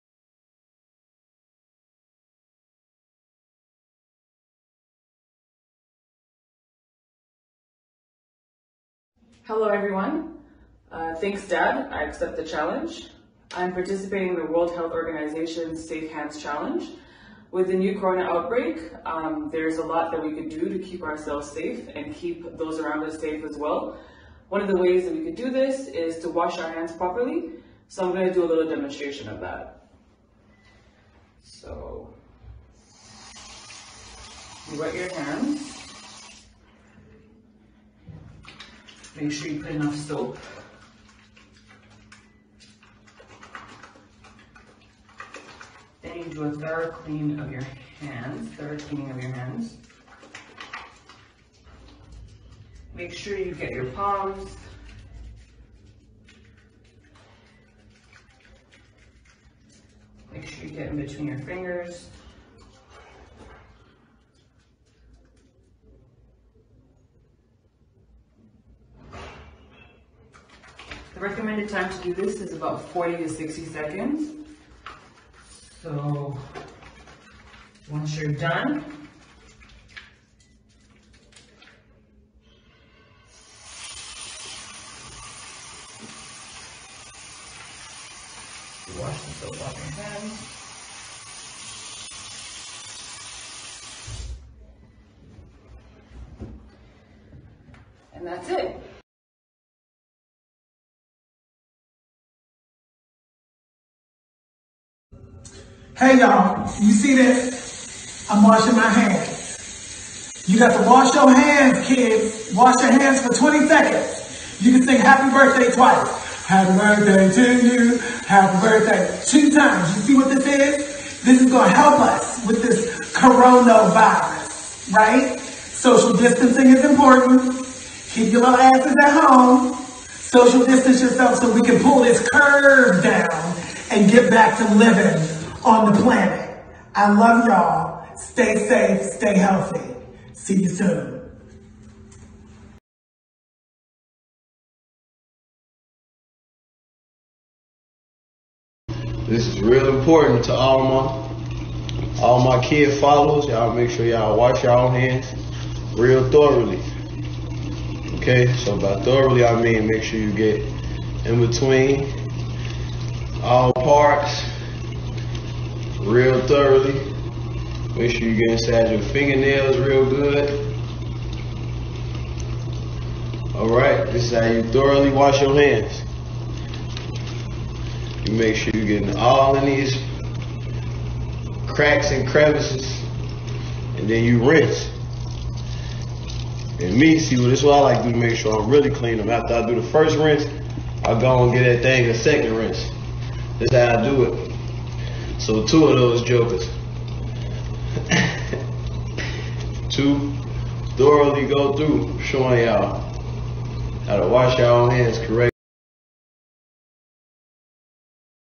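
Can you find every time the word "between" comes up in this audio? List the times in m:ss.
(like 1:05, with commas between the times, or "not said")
1:00, 2:41.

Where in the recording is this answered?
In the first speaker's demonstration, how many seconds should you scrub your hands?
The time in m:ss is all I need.
1:12.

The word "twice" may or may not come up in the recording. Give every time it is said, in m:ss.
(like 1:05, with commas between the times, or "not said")
1:55.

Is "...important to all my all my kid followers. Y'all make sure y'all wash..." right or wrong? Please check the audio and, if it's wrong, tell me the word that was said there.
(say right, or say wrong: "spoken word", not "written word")
right.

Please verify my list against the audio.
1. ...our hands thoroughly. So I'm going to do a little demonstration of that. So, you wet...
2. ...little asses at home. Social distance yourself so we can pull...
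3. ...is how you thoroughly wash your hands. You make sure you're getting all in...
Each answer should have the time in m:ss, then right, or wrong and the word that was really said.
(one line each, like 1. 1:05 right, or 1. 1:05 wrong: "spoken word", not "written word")
1. 0:26 wrong: "properly", not "thoroughly"
2. 2:08 right
3. 2:54 right.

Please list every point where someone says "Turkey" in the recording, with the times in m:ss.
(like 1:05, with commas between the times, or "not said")
not said.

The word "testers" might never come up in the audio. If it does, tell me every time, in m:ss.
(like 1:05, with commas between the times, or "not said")
not said.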